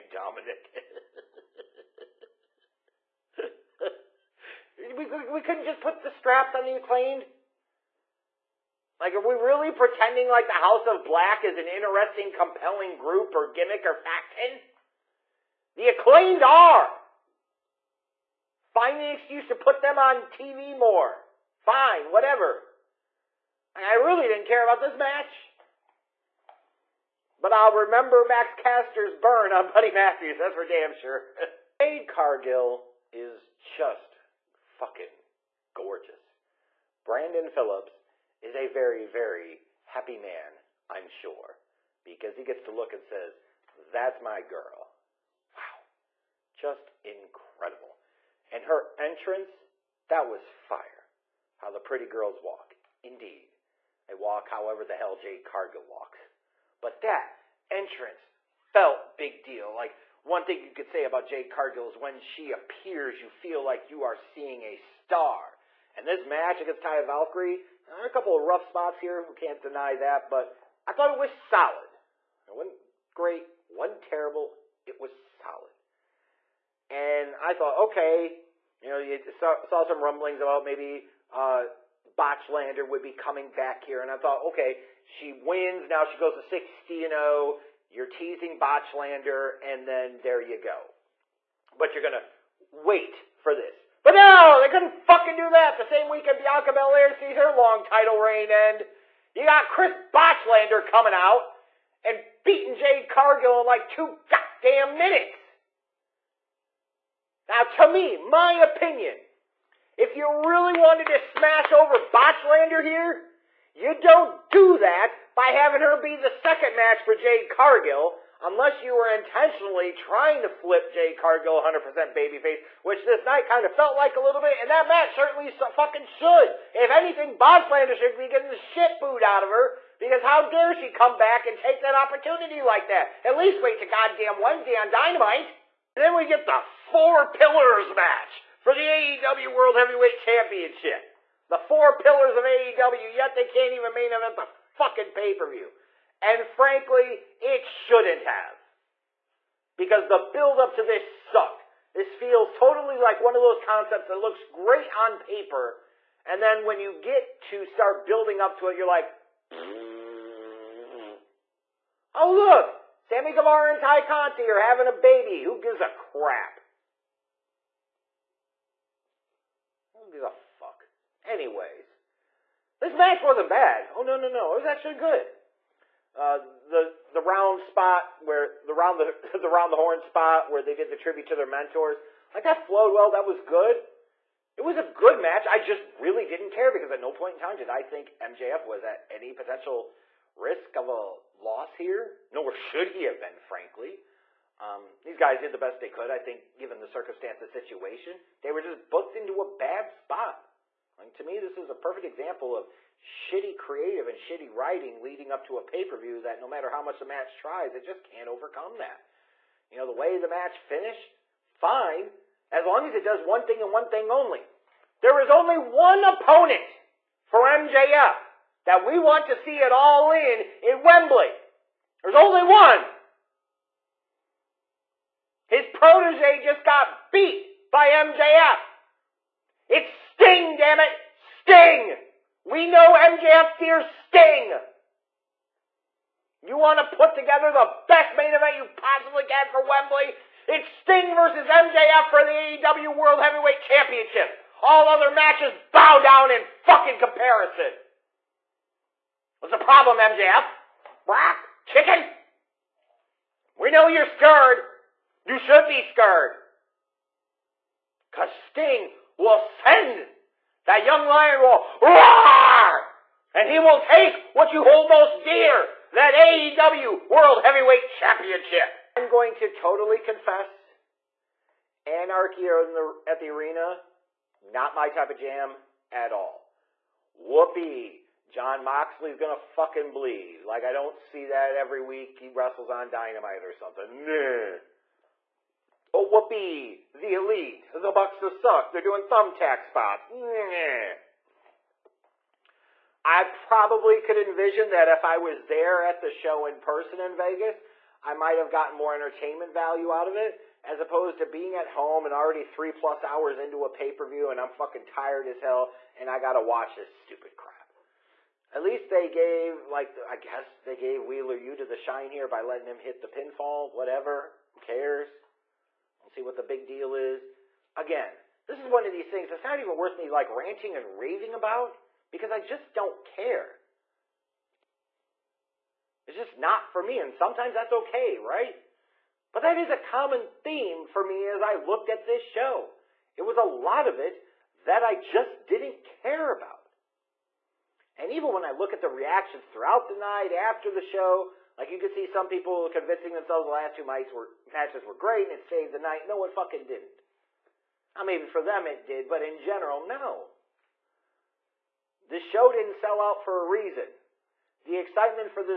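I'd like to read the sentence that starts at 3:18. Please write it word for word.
They were just booked into a bad spot.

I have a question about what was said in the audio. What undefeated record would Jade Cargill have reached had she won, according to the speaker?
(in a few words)
60 and 0.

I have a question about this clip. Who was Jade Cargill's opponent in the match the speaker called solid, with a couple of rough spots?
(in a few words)
Taya Valkyrie.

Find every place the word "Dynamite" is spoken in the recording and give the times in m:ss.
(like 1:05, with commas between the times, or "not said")
2:14, 4:42.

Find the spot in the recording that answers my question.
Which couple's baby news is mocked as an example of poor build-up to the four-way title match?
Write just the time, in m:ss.
2:43.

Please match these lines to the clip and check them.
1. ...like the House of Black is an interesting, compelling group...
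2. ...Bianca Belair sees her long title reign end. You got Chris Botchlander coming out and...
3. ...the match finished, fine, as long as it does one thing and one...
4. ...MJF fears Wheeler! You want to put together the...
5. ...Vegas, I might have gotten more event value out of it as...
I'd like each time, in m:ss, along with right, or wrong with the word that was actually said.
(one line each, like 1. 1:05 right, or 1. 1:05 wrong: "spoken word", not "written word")
1. 0:10 right
2. 1:36 right
3. 3:30 right
4. 3:52 wrong: "Sting", not "Wheeler"
5. 4:57 wrong: "entertainment", not "event".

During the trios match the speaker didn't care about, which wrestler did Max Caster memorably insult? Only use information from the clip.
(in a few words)
Buddy Matthews.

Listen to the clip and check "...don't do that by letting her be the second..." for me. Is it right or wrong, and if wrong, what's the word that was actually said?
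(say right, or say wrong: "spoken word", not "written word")
wrong: "having", not "letting".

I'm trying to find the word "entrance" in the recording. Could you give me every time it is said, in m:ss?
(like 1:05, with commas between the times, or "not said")
0:48, 0:57.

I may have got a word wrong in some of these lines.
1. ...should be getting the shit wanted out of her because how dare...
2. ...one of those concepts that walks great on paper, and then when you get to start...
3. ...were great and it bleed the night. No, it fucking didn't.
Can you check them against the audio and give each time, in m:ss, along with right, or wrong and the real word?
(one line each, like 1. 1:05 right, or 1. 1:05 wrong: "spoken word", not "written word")
1. 2:07 wrong: "booed", not "wanted"
2. 2:33 wrong: "looks", not "walks"
3. 5:44 wrong: "saved", not "bleed".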